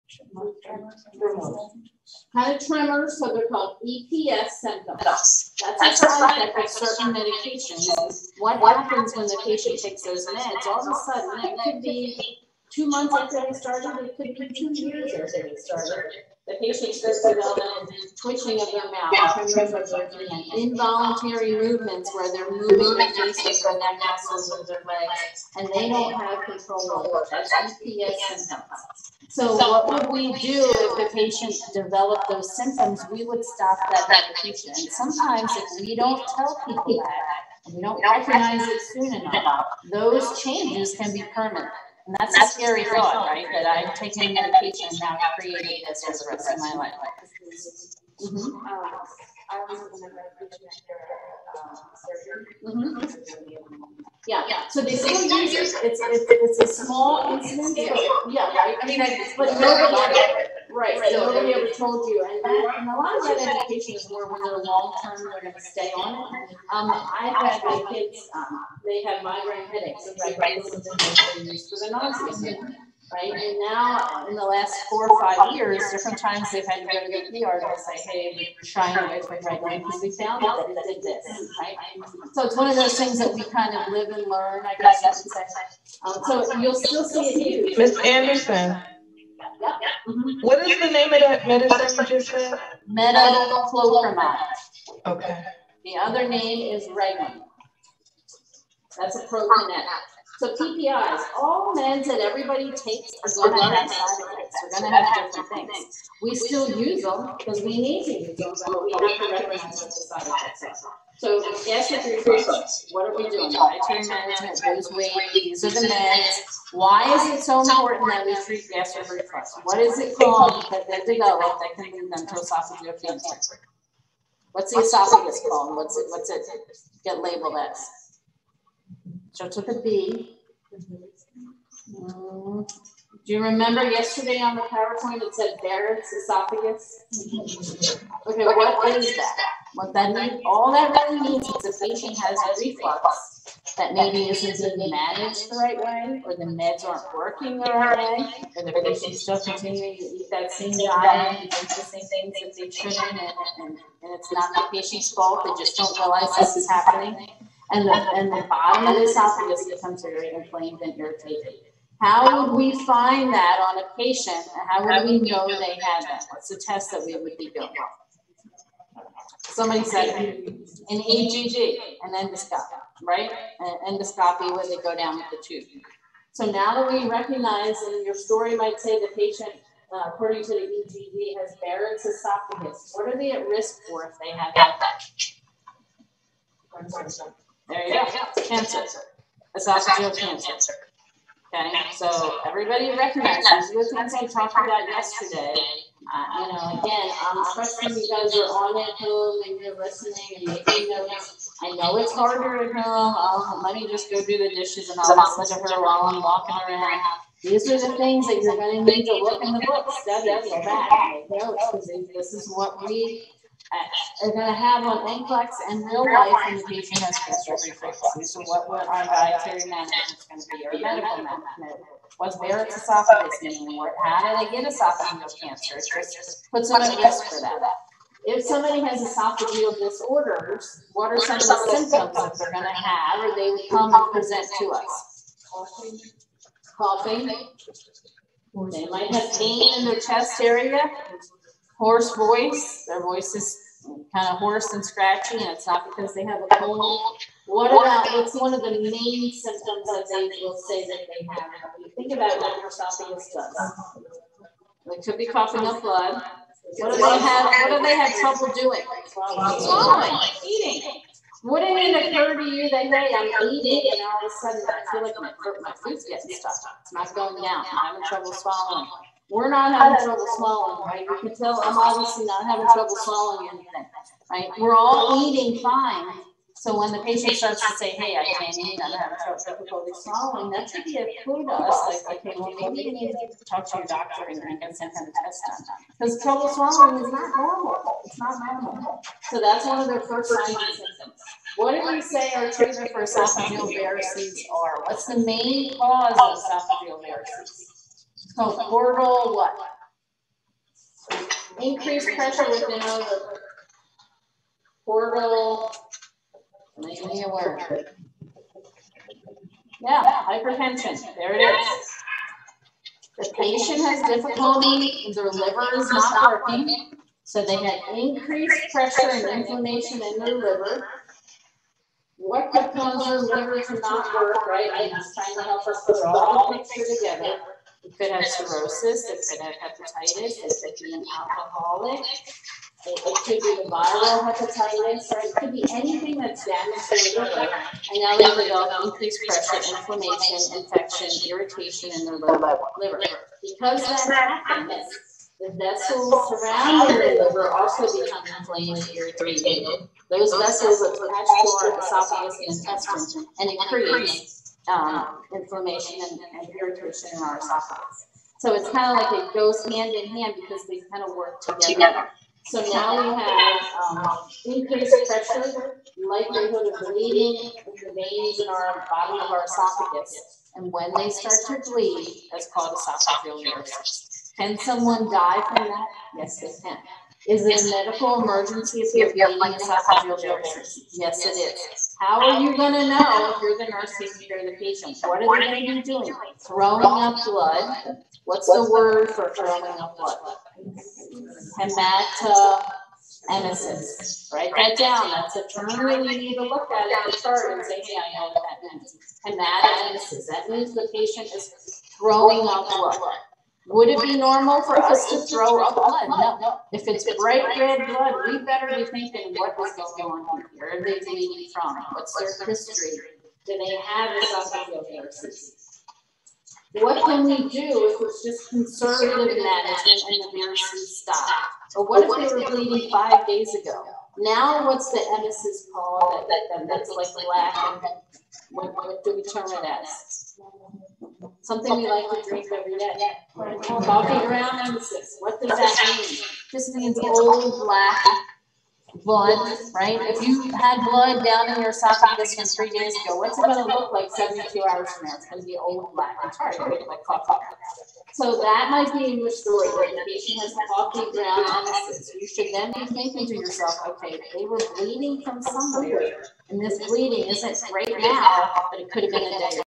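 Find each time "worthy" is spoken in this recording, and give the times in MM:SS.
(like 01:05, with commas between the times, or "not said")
not said.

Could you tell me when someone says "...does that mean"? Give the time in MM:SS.
07:15.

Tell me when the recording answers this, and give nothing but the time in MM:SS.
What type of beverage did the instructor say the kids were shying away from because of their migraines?
01:19.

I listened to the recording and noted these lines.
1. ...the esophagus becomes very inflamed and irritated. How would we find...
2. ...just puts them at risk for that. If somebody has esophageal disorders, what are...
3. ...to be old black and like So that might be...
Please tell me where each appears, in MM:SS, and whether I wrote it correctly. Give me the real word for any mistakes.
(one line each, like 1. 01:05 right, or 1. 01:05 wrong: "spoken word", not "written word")
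1. 02:38 right
2. 03:45 right
3. 07:25 right.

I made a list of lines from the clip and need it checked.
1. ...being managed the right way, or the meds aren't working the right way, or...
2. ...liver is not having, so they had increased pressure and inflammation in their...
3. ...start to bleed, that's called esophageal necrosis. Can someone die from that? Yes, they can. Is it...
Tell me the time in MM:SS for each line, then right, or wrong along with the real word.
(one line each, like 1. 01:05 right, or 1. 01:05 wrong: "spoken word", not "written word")
1. 02:24 right
2. 05:15 wrong: "working", not "having"
3. 06:11 right.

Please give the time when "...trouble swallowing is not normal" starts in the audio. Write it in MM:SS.
04:46.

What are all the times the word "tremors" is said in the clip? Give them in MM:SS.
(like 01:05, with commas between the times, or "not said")
00:02, 00:19.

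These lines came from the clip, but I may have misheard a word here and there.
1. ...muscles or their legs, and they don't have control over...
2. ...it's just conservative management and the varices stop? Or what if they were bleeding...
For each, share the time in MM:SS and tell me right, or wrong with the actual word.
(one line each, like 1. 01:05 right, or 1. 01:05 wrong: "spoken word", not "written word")
1. 00:23 right
2. 06:58 right.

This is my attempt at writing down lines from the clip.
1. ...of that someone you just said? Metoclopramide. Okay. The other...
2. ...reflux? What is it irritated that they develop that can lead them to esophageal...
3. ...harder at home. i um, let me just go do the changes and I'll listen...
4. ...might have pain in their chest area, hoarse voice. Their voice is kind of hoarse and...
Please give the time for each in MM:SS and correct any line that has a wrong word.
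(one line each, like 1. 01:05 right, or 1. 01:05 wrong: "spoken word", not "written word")
1. 01:31 wrong: "medicine", not "someone"
2. 01:59 wrong: "called", not "irritated"
3. 03:22 wrong: "dishes", not "changes"
4. 03:58 right.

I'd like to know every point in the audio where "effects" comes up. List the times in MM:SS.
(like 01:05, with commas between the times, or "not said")
00:06, 01:44, 01:50.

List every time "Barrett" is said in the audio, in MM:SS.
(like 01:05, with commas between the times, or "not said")
02:15, 03:01.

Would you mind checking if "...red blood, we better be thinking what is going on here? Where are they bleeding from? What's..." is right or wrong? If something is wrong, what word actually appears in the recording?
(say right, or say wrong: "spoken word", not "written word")
right.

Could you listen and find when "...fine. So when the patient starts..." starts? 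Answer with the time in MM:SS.
04:35.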